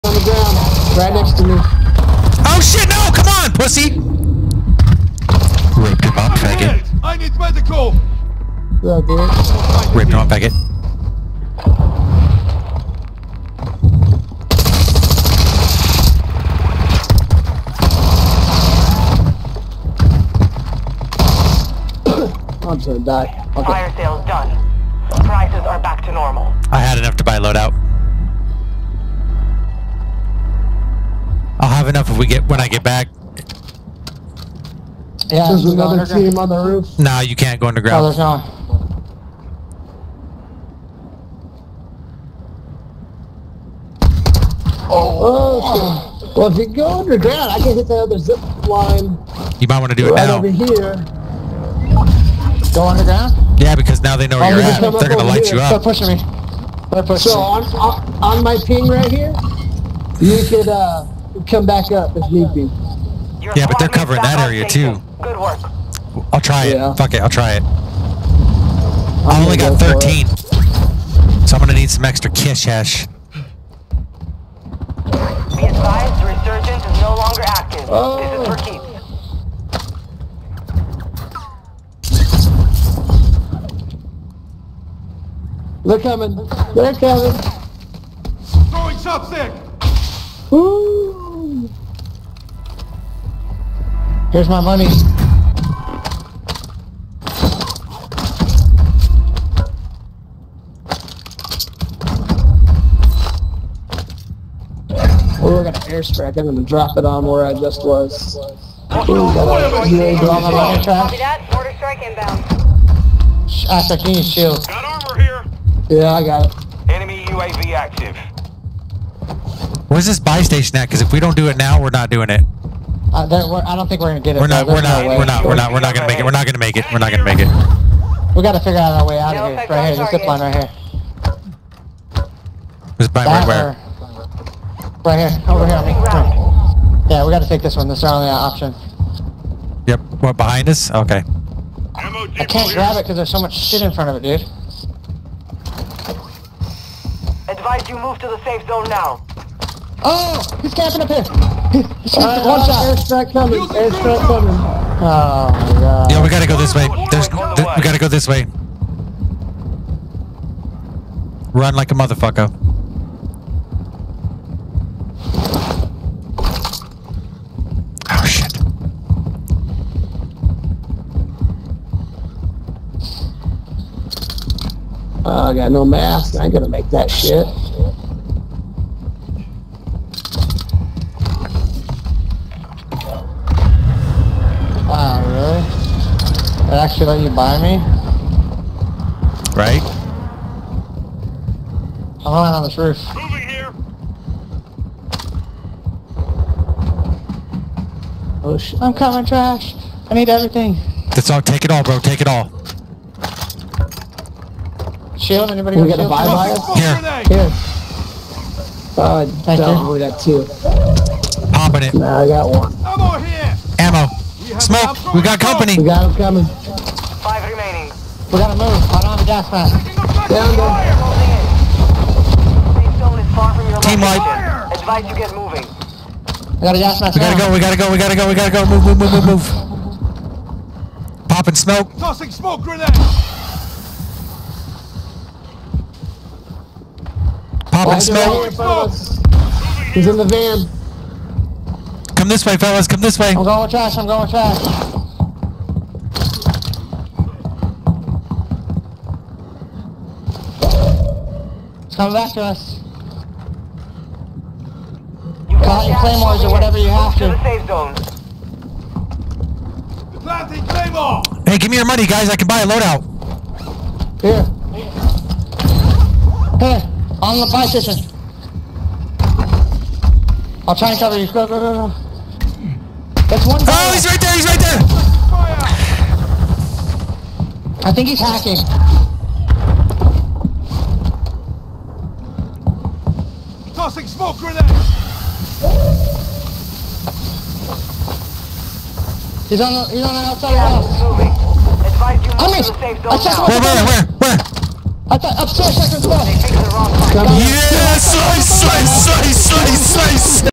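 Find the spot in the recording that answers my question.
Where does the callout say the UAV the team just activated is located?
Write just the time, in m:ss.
1:50.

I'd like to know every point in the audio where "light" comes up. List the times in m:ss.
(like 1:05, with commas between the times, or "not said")
0:55, 3:44.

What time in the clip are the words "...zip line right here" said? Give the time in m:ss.
2:10.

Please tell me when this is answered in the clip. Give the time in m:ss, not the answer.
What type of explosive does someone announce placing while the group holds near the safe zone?
4:20.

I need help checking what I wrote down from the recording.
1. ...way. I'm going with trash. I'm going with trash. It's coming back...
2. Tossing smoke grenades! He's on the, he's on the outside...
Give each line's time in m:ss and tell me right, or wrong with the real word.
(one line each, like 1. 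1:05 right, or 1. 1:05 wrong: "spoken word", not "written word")
1. 4:03 right
2. 4:43 right.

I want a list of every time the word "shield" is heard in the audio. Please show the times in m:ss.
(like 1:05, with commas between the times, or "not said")
1:54, 3:25.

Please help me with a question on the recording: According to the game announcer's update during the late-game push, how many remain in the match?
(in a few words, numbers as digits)
5.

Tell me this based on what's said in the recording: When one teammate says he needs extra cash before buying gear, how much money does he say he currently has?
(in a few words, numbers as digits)
13.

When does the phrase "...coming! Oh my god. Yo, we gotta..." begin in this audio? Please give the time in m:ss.
2:34.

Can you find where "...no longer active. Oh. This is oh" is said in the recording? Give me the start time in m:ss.
1:17.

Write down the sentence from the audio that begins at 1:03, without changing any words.
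yeah, but they're covering that area too.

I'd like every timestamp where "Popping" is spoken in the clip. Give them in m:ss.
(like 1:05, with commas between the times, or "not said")
3:31, 3:51, 3:57.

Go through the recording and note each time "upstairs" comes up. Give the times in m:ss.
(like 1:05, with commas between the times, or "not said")
4:55.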